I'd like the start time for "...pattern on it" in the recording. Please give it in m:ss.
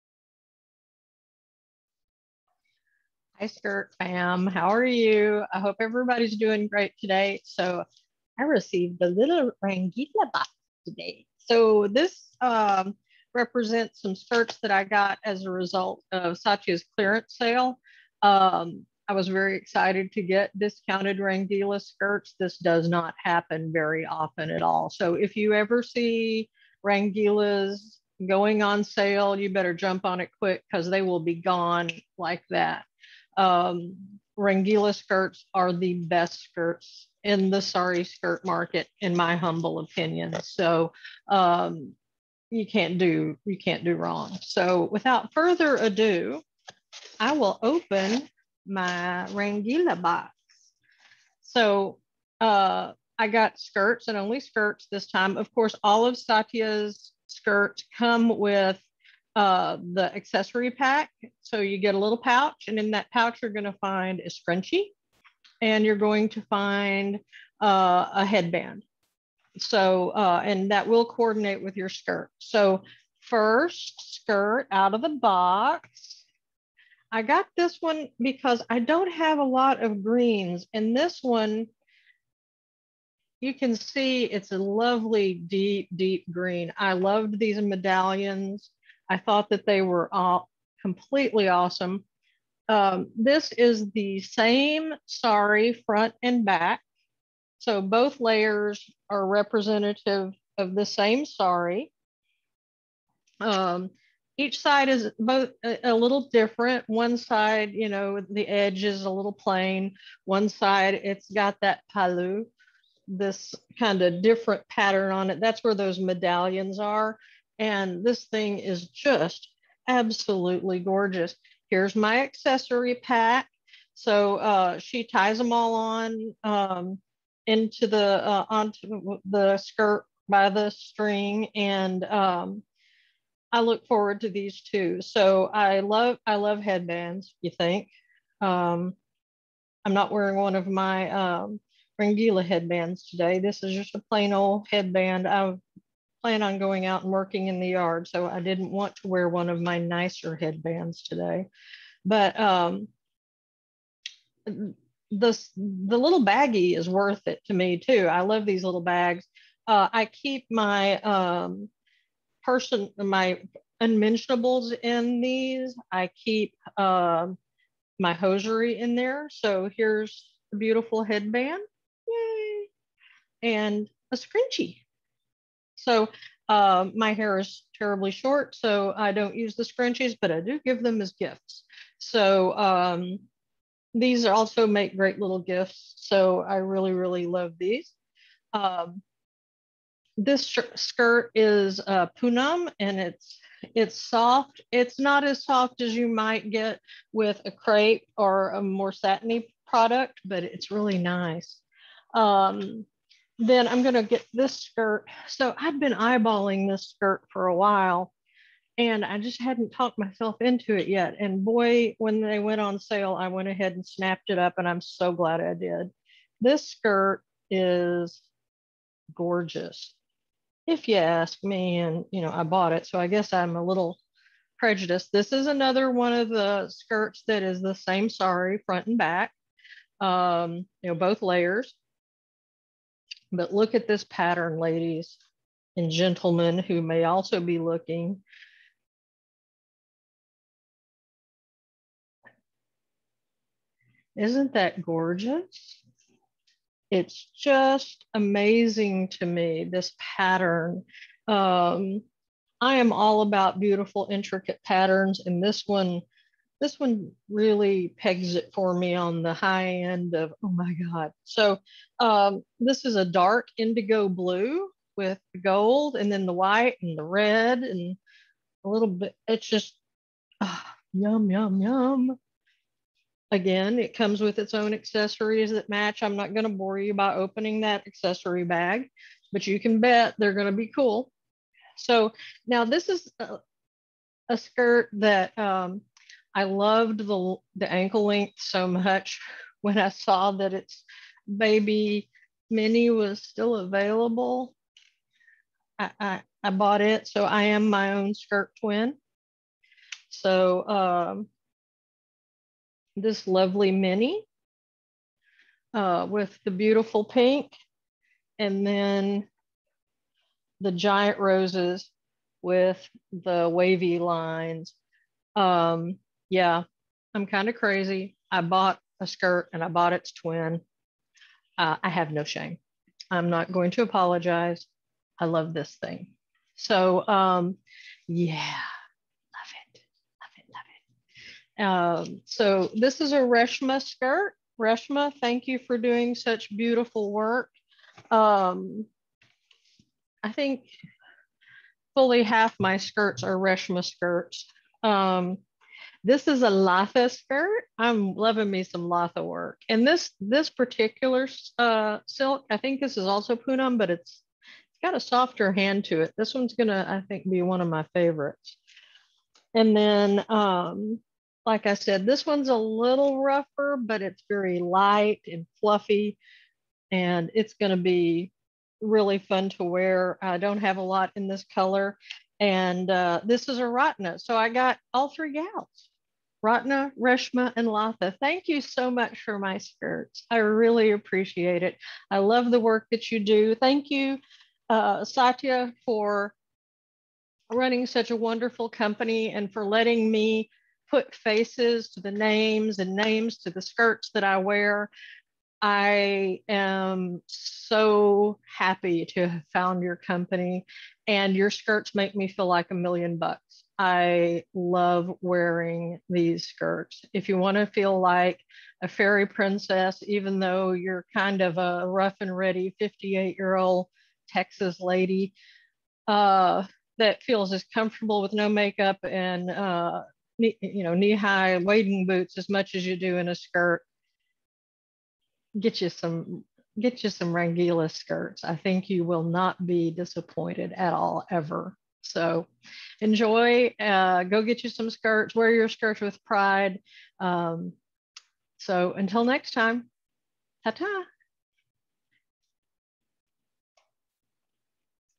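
1:54.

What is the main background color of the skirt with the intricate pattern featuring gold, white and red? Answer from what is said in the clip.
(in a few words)
Dark indigo blue.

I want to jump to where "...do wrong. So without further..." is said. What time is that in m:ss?
0:43.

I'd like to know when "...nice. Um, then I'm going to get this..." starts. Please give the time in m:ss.
3:20.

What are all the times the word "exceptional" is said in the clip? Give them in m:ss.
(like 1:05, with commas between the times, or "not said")
not said.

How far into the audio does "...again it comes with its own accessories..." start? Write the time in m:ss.
4:33.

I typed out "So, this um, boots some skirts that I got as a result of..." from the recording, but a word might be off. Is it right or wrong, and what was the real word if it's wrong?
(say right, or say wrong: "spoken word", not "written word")
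wrong: "represents", not "boots".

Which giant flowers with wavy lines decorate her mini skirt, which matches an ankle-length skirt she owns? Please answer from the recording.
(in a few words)
Roses.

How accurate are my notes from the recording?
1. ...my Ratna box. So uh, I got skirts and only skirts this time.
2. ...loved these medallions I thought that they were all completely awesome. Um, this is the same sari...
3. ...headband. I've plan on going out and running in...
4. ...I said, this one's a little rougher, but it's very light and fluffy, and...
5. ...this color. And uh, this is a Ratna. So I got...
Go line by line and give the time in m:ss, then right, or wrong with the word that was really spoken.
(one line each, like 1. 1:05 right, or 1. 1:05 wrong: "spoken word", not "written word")
1. 0:48 wrong: "Rangeelaa", not "Ratna"
2. 1:26 right
3. 2:24 wrong: "working", not "running"
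4. 6:01 right
5. 6:11 right.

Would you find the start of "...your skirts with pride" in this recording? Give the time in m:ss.
7:15.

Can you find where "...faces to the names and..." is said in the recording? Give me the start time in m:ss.
6:31.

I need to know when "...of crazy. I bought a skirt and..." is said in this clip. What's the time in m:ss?
5:17.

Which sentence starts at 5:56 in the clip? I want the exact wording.
This one's gonna, I think, be one of my favorites.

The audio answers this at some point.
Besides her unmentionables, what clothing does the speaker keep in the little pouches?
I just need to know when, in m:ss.
2:48.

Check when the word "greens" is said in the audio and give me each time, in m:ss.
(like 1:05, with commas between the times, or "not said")
1:20, 1:26.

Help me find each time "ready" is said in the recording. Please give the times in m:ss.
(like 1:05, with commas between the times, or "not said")
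6:52.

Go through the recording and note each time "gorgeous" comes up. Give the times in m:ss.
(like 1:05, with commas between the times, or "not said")
2:00, 3:39, 4:04.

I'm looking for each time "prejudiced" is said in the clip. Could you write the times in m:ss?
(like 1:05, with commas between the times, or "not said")
3:44.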